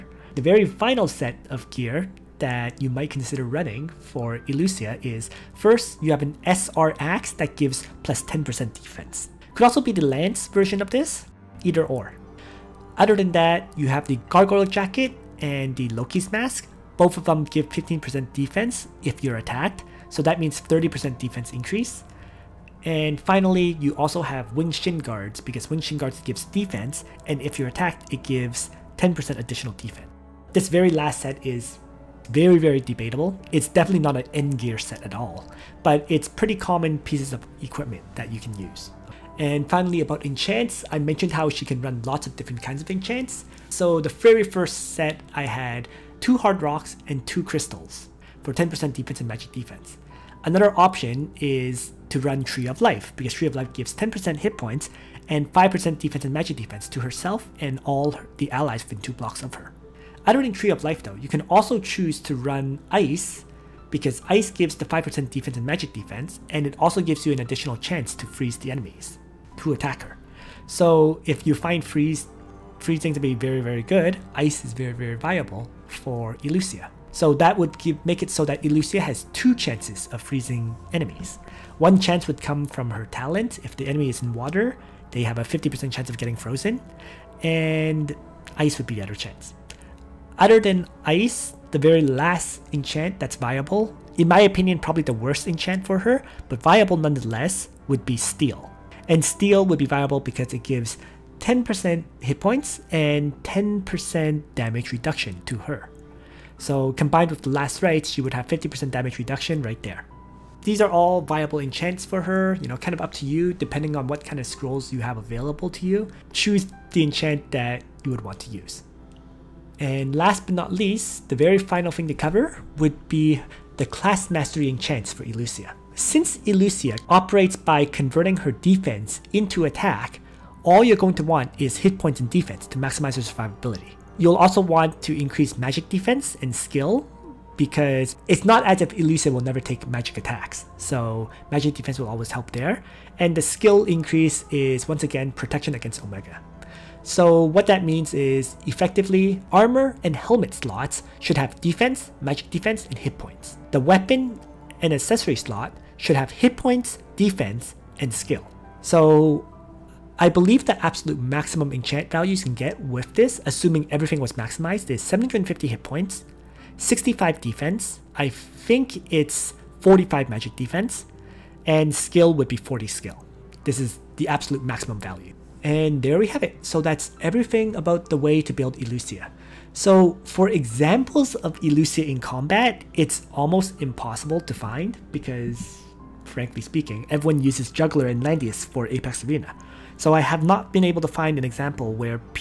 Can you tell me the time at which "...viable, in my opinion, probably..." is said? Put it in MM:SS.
01:33.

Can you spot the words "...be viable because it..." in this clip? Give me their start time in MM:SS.
01:39.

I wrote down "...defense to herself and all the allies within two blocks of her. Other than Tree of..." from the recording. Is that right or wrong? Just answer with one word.
right.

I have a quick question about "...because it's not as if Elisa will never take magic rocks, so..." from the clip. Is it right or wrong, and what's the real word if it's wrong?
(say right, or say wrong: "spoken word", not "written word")
wrong: "attacks", not "rocks".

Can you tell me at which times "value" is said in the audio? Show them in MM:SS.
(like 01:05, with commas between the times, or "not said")
02:42, 02:55.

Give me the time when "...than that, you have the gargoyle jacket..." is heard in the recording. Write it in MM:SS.
00:13.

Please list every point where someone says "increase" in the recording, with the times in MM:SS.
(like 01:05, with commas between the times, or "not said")
00:21, 02:15, 02:23.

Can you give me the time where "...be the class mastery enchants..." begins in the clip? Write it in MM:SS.
02:03.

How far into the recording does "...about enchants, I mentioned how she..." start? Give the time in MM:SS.
00:40.